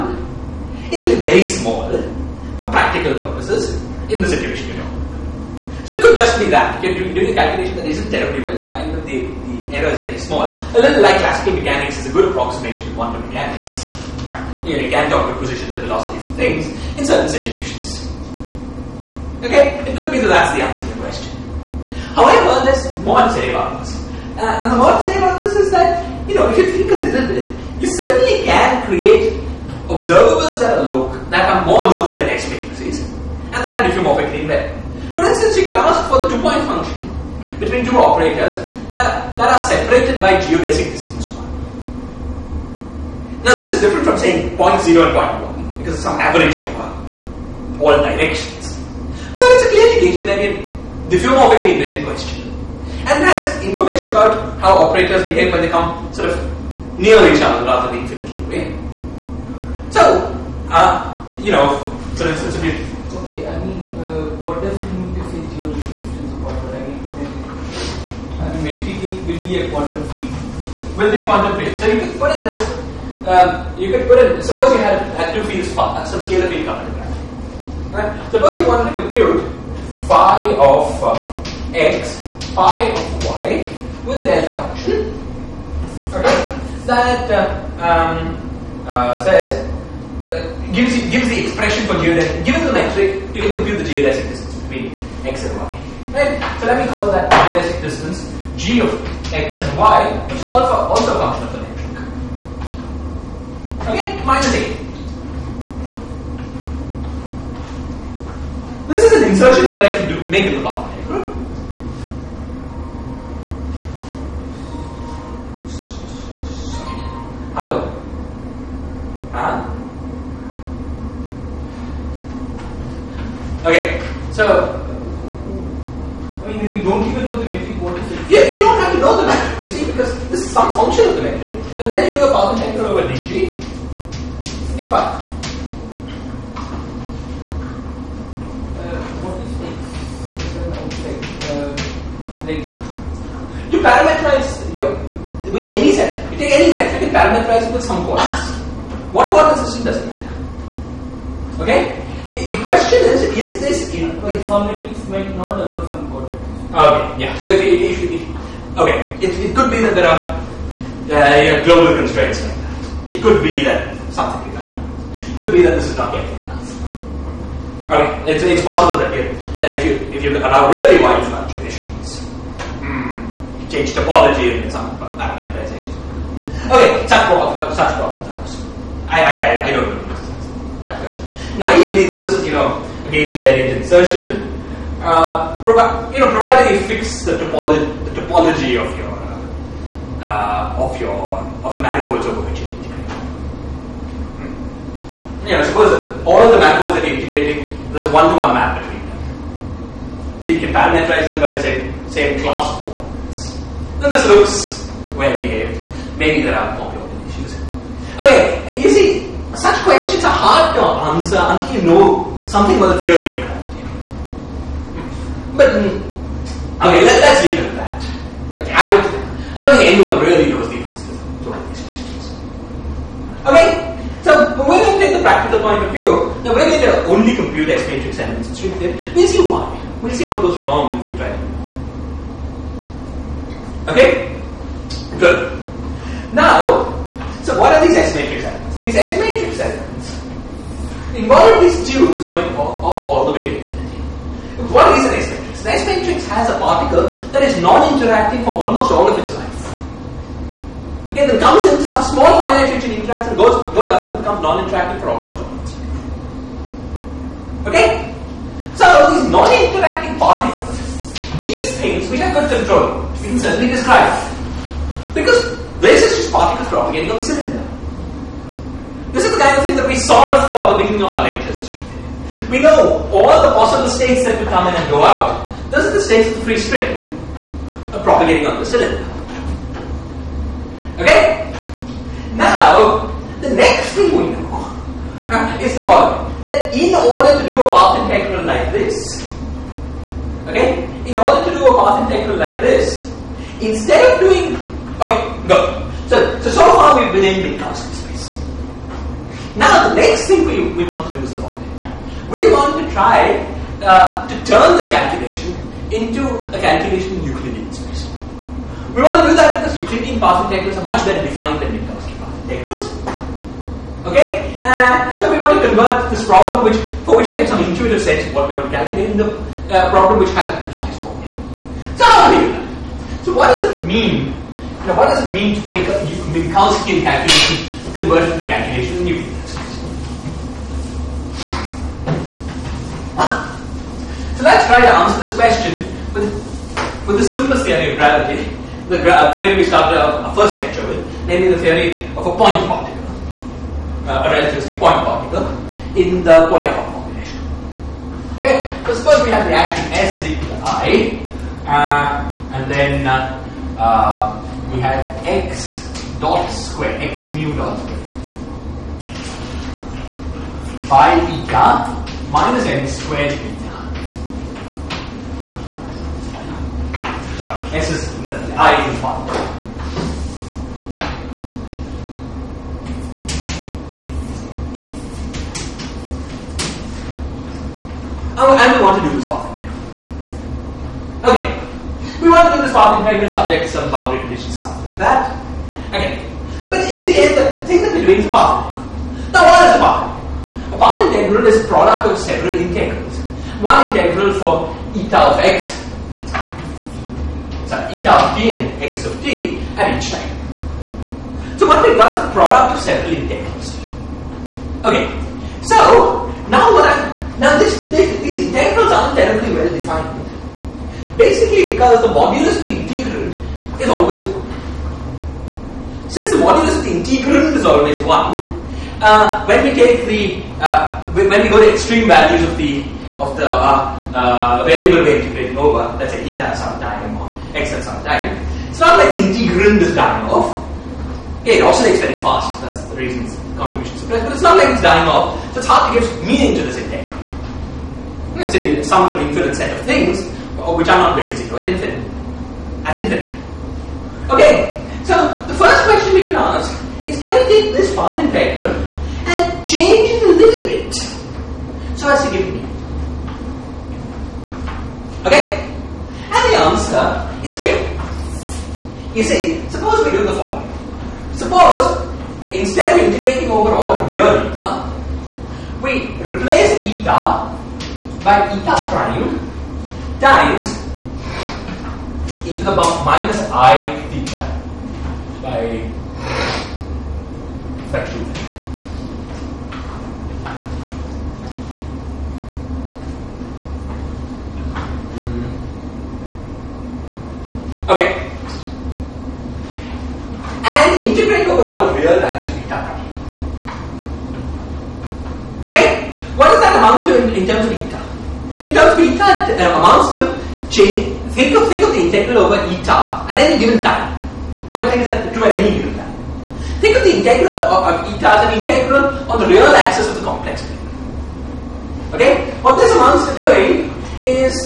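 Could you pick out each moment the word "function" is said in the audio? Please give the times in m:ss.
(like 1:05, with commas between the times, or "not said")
0:36, 1:24, 1:41, 2:10.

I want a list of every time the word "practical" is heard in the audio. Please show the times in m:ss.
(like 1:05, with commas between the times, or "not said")
0:02, 3:45.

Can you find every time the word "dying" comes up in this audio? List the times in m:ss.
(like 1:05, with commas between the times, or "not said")
7:09, 7:14.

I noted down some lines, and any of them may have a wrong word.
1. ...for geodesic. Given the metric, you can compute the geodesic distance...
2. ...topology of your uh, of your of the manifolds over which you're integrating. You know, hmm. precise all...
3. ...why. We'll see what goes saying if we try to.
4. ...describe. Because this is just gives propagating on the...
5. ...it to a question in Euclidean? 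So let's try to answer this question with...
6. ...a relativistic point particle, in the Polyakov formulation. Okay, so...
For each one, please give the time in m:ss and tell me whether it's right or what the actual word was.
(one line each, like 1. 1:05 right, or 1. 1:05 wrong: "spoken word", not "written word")
1. 1:31 right
2. 3:08 wrong: "suppose", not "precise"
3. 3:49 wrong: "wrong", not "saying"
4. 4:23 wrong: "particles", not "gives"
5. 5:28 wrong: "calculation", not "question"
6. 5:44 right.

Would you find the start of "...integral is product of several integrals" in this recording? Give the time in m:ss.
6:31.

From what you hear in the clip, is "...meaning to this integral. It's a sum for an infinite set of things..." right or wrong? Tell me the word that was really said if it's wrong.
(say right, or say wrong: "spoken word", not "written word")
right.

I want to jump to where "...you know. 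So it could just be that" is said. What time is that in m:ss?
0:04.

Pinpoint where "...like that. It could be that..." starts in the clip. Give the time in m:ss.
2:42.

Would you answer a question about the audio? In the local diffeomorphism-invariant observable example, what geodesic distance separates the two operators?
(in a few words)
1.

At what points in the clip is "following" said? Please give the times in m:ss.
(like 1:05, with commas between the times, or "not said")
4:45, 5:01, 7:40.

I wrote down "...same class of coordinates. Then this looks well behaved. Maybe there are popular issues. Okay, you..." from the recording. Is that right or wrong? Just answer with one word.
right.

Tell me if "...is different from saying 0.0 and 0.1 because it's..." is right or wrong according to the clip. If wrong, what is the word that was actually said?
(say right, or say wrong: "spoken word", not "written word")
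right.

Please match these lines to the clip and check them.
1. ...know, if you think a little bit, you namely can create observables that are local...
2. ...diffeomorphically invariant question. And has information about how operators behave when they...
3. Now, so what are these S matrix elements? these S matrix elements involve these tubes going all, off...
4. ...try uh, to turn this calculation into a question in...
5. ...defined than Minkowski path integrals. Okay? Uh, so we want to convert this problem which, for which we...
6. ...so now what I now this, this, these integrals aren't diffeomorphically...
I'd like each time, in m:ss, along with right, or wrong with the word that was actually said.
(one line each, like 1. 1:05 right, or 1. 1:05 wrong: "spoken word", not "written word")
1. 0:26 wrong: "certainly", not "namely"
2. 0:51 right
3. 3:56 right
4. 5:02 wrong: "calculation", not "question"
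5. 5:11 right
6. 6:45 wrong: "terribly", not "diffeomorphically".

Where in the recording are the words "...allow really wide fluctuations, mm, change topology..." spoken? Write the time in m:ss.
2:50.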